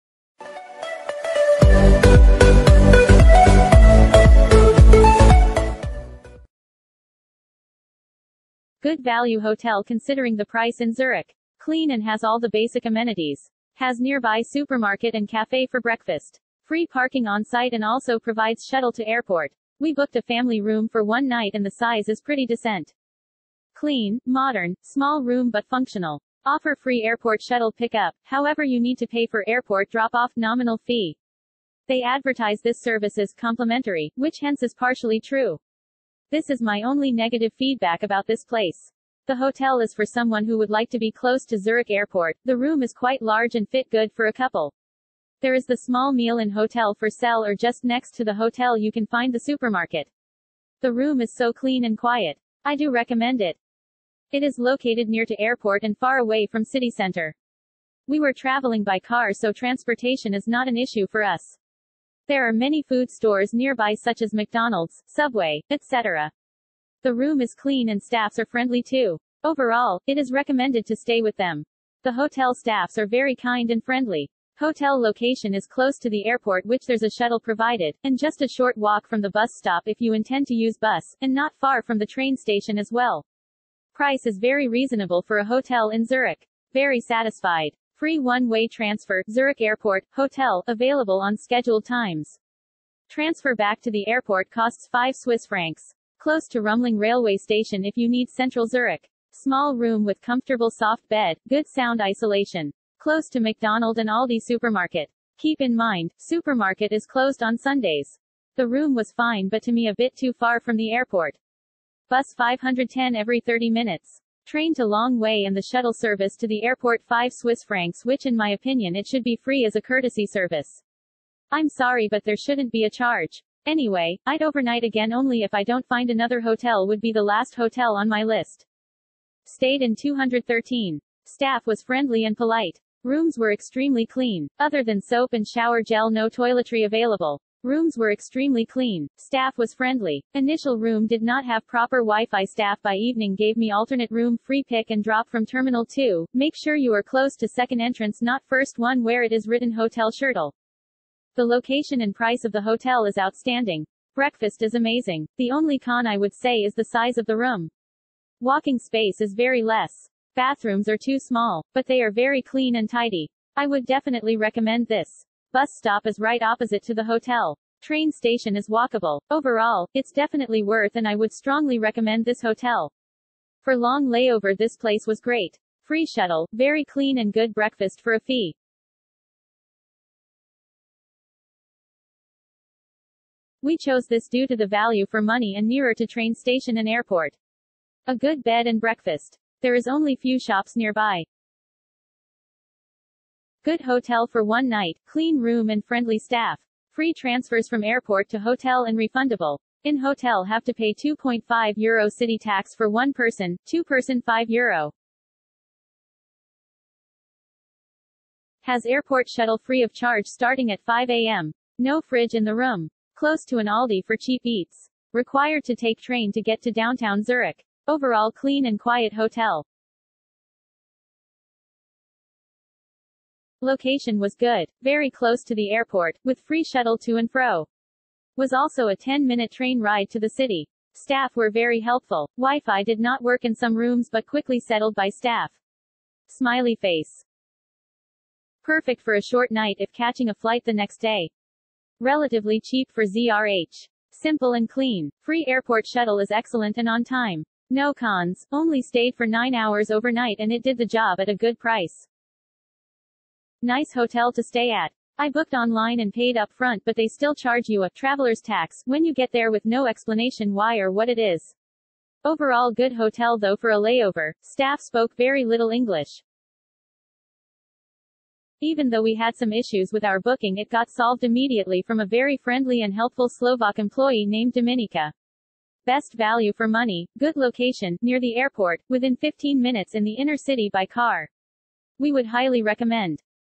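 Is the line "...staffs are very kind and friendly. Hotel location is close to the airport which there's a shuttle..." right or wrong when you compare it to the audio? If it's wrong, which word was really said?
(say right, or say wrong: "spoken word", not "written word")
right.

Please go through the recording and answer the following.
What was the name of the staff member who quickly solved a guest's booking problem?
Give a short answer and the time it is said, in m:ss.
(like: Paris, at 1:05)
Dominika, at 4:34.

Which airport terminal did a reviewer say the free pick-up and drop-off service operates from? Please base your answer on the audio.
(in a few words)
Terminal 2.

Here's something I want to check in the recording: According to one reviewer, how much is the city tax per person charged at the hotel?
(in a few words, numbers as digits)
2.5 euro.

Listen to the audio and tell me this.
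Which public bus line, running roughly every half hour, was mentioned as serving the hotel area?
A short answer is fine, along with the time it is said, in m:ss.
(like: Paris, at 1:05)
510, at 1:52.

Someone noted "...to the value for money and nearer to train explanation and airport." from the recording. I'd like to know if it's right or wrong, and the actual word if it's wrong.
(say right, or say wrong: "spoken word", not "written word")
wrong: "station", not "explanation".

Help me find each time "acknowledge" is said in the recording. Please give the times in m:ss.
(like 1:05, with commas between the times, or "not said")
not said.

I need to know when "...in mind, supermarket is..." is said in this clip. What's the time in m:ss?
1:45.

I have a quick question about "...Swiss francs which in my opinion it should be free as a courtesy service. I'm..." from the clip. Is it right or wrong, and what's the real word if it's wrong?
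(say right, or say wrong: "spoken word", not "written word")
right.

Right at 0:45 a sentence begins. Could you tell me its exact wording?
There is the small meal in hotel for sale or just next to the hotel you can find the supermarket.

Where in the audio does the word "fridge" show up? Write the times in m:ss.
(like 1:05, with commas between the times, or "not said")
3:32.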